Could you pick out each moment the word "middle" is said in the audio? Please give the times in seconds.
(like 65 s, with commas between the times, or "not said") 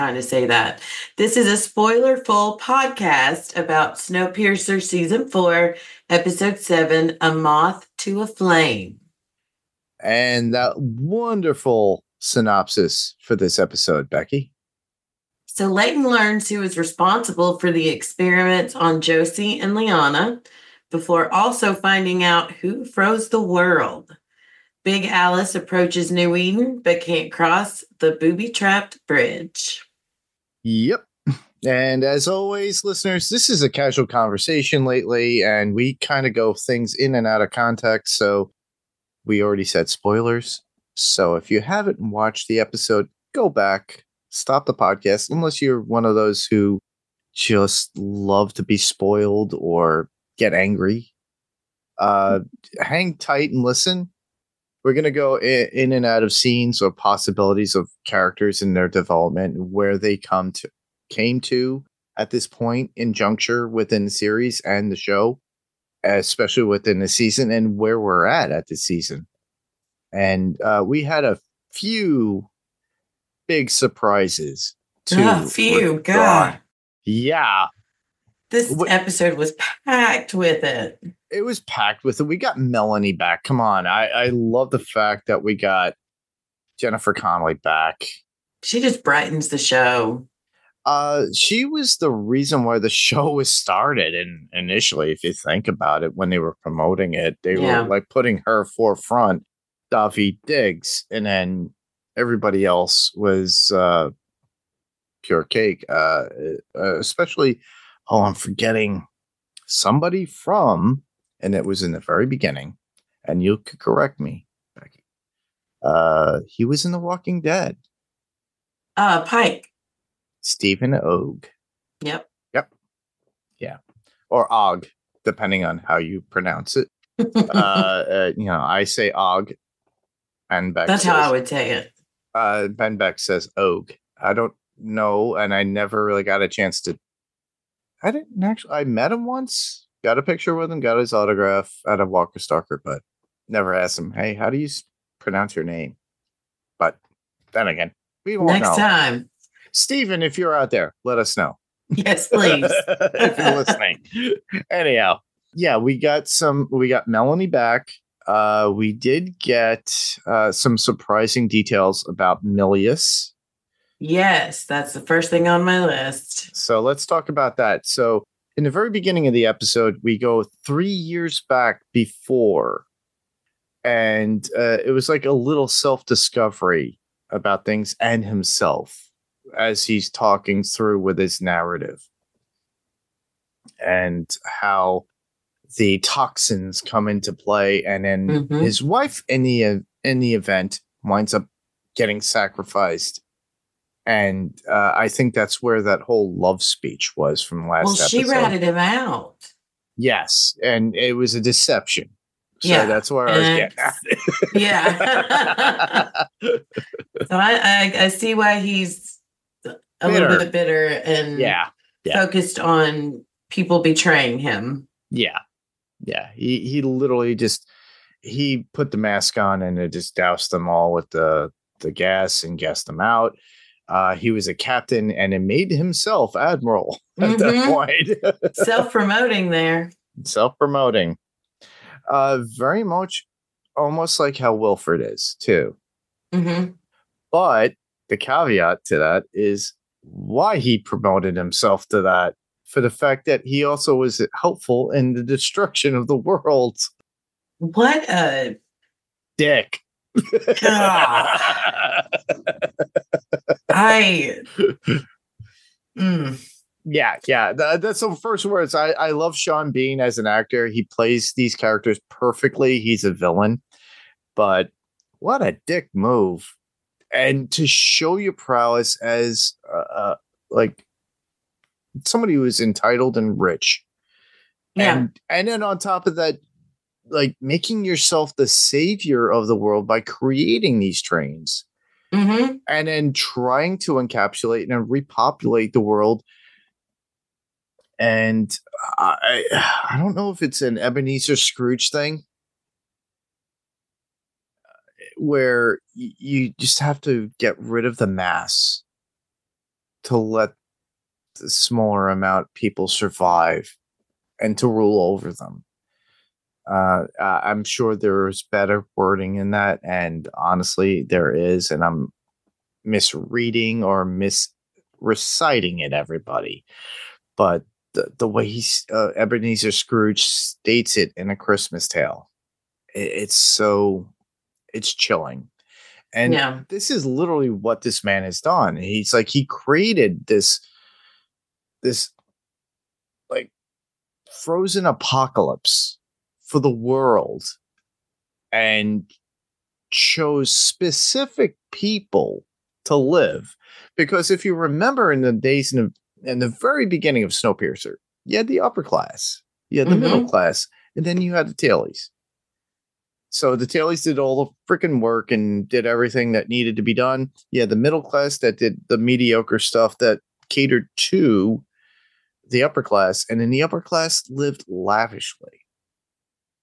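350 s, 357 s.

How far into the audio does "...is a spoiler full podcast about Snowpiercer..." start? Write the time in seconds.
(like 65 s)
1 s.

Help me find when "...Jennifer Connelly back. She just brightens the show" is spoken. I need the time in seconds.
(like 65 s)
86 s.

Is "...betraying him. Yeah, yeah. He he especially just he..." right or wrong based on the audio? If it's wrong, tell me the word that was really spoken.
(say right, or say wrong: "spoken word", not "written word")
wrong: "literally", not "especially".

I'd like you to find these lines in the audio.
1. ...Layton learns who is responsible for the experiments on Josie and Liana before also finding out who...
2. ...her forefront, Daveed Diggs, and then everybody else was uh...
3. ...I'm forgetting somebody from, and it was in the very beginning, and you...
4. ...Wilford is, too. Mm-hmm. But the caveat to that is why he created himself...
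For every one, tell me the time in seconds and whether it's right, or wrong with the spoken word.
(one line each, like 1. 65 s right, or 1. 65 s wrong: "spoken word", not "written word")
1. 15 s right
2. 98 s right
3. 108 s right
4. 234 s wrong: "promoted", not "created".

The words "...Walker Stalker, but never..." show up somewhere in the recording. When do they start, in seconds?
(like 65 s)
142 s.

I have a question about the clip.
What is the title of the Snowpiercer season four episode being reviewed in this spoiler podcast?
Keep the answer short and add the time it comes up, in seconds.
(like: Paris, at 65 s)
A Moth to a Flame, at 7 s.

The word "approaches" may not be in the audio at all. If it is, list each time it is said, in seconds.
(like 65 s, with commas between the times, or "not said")
25 s.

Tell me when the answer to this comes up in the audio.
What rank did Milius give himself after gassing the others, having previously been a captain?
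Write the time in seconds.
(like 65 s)
226 s.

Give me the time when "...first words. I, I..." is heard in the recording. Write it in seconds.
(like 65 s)
258 s.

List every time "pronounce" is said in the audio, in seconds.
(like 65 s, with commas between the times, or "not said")
126 s, 145 s.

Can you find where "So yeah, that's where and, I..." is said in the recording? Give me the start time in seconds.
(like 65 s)
202 s.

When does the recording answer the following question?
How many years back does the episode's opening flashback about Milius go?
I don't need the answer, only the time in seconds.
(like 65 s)
170 s.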